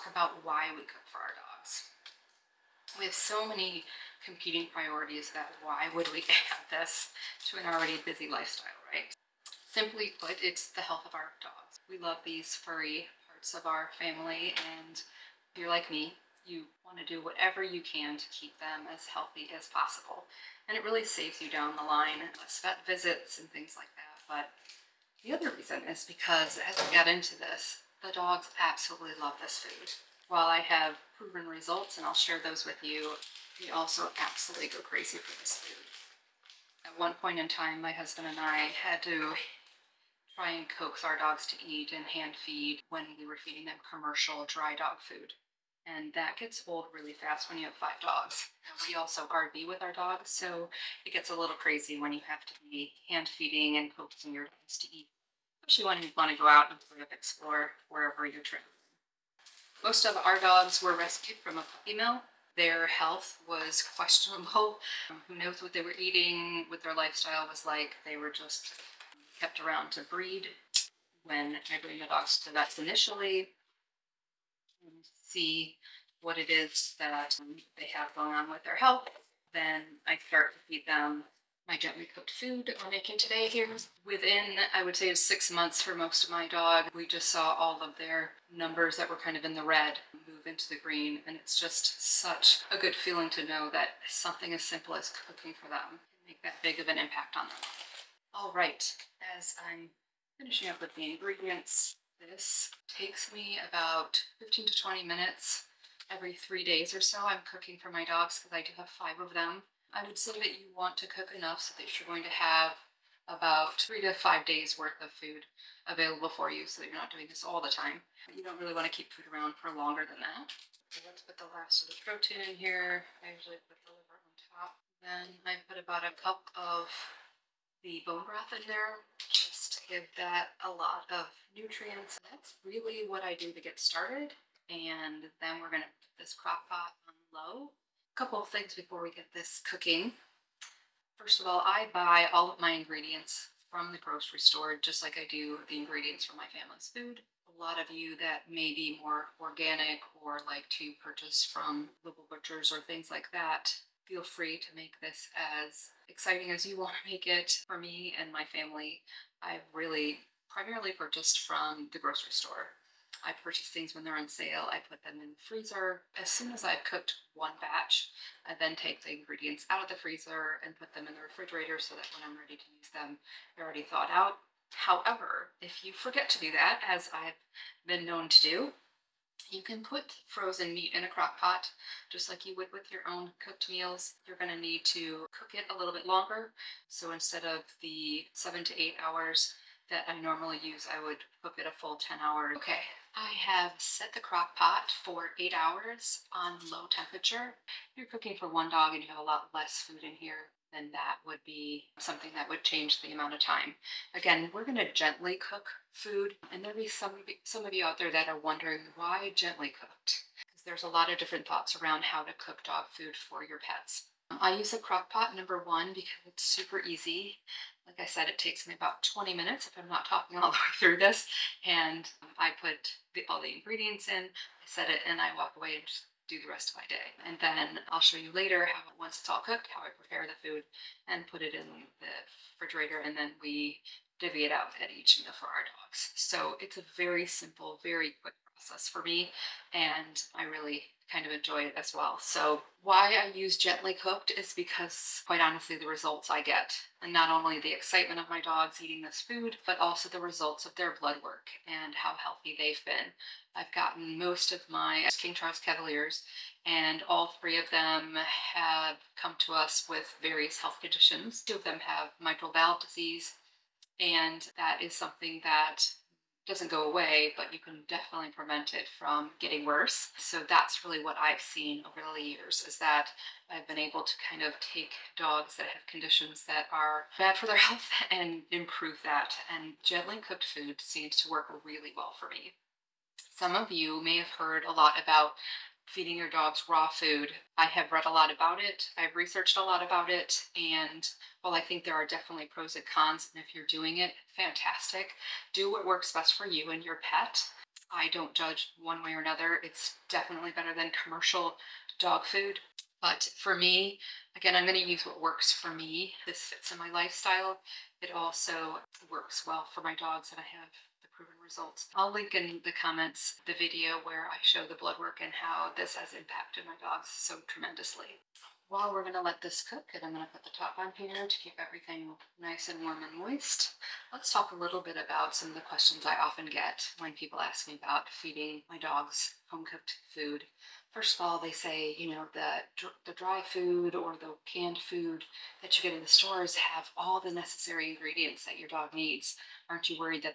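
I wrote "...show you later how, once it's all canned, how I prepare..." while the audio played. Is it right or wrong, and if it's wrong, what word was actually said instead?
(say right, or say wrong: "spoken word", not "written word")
wrong: "cooked", not "canned".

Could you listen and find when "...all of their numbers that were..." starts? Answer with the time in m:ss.
1:27.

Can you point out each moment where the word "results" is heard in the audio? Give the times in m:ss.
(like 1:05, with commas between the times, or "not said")
0:31, 4:05, 4:10, 5:11.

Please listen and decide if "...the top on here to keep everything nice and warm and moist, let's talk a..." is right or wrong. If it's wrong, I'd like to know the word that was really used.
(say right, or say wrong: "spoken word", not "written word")
right.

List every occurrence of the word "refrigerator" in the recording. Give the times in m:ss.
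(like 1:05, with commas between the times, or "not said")
2:51, 3:52.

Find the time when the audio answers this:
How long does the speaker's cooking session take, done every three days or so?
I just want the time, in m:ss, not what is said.
1:44.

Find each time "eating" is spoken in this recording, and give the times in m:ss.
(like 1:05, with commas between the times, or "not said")
1:05, 4:08.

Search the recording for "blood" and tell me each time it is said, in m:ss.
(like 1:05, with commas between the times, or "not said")
4:10, 5:14.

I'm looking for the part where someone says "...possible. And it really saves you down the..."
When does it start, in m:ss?
0:19.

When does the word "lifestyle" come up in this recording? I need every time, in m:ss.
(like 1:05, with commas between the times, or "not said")
0:08, 1:06, 5:06.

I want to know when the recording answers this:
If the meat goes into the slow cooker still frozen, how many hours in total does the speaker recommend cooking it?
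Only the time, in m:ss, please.
3:11.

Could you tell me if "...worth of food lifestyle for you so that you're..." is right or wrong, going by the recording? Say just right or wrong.
wrong.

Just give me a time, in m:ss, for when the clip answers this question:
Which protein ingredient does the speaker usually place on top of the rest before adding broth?
2:03.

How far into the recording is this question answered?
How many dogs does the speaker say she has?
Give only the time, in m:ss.
0:47.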